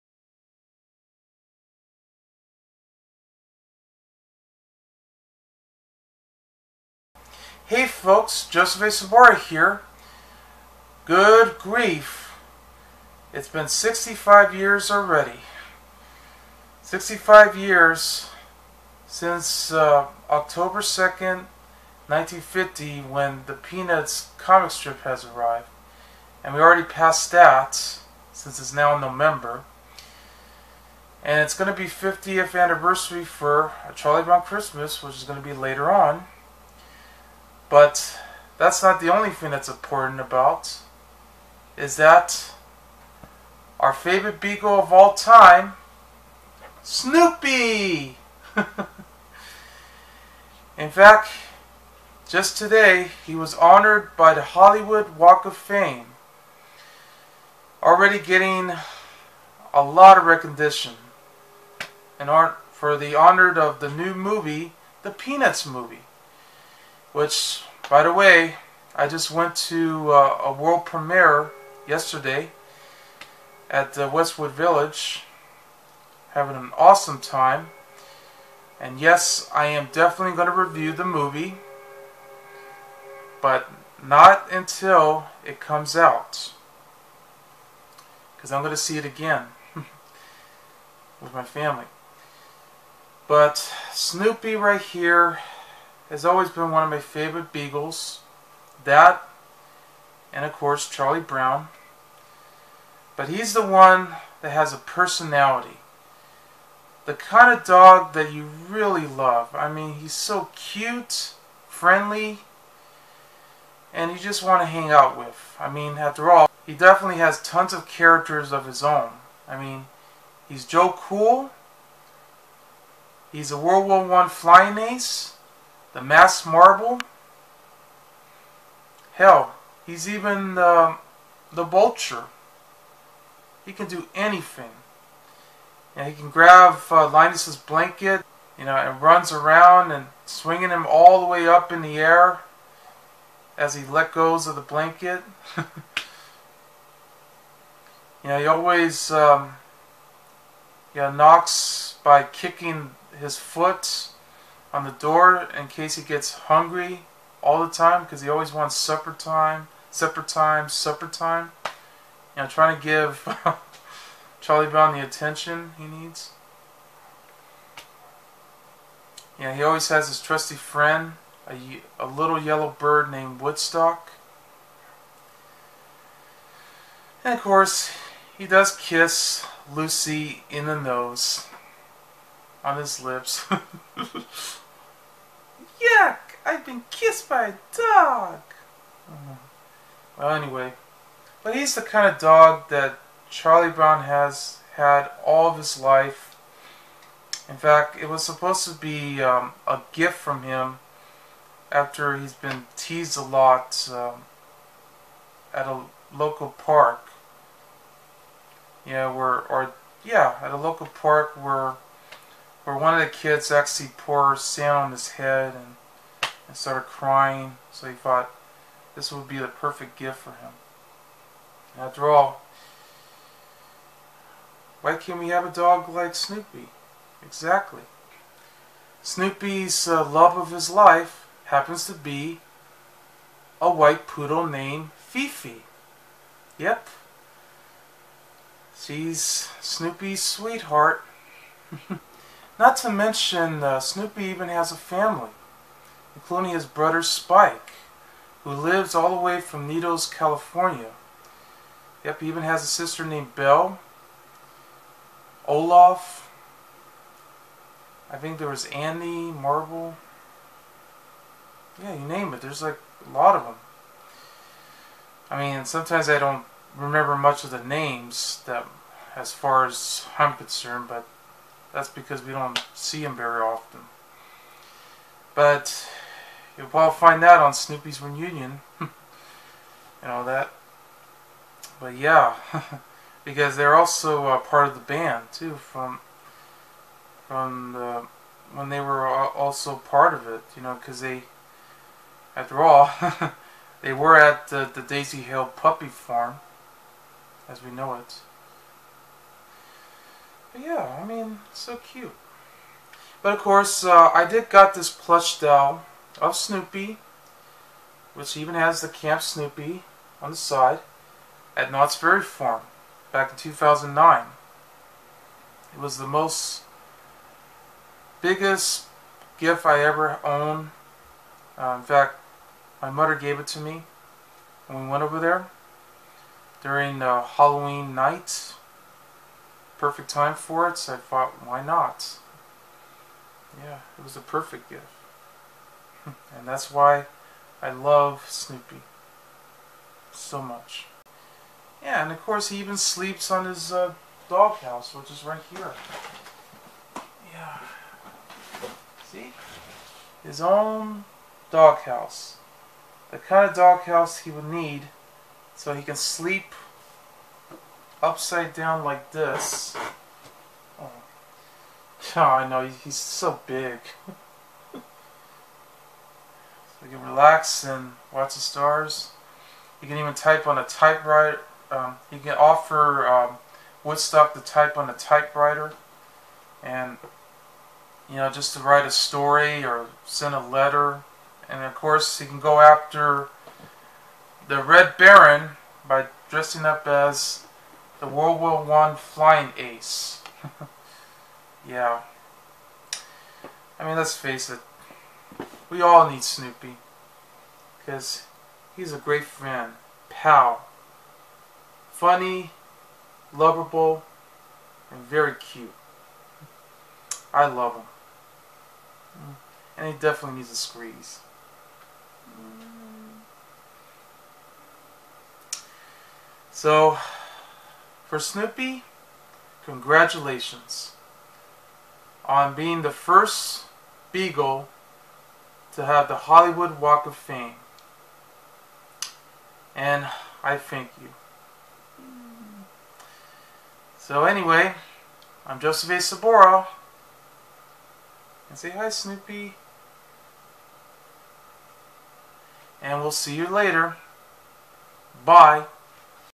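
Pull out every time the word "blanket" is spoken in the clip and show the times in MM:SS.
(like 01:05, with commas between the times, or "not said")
02:17, 02:24.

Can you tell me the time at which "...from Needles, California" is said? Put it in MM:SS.
04:09.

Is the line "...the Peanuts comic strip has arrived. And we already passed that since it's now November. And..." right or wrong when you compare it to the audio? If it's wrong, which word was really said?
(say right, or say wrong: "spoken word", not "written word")
right.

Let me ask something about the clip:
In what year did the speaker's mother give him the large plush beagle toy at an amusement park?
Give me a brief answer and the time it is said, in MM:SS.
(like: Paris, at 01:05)
2009, at 05:13.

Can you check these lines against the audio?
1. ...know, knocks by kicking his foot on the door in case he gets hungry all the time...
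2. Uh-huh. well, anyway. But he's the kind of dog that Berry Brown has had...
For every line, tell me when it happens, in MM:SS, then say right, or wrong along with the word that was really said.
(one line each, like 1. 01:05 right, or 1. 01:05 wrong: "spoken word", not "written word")
1. 02:31 right
2. 03:09 wrong: "Charlie", not "Berry".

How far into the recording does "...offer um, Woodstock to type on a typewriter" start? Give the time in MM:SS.
06:12.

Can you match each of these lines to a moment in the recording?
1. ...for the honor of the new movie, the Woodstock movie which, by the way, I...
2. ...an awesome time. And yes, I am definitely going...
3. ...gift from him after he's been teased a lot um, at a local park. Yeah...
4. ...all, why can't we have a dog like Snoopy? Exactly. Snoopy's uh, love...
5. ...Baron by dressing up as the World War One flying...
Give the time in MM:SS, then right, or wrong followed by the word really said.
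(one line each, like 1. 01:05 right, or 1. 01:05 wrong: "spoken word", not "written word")
1. 01:02 wrong: "Peanuts", not "Woodstock"
2. 01:16 right
3. 03:19 right
4. 03:42 right
5. 06:24 right.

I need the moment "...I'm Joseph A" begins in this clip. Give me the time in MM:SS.
07:15.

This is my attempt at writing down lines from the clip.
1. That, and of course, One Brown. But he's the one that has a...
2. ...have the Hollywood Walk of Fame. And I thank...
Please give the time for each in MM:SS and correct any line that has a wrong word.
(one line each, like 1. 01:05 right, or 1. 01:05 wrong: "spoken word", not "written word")
1. 01:38 wrong: "Charlie", not "One"
2. 07:05 right.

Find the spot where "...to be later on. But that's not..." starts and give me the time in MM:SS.
00:35.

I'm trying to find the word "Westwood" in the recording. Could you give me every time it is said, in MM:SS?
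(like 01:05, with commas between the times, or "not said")
01:14.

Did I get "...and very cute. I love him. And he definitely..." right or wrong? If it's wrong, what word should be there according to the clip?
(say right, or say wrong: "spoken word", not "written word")
right.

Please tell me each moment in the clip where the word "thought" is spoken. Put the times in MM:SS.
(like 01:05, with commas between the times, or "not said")
03:37, 05:30.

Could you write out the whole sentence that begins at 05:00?
But yeah, I mean, so cute.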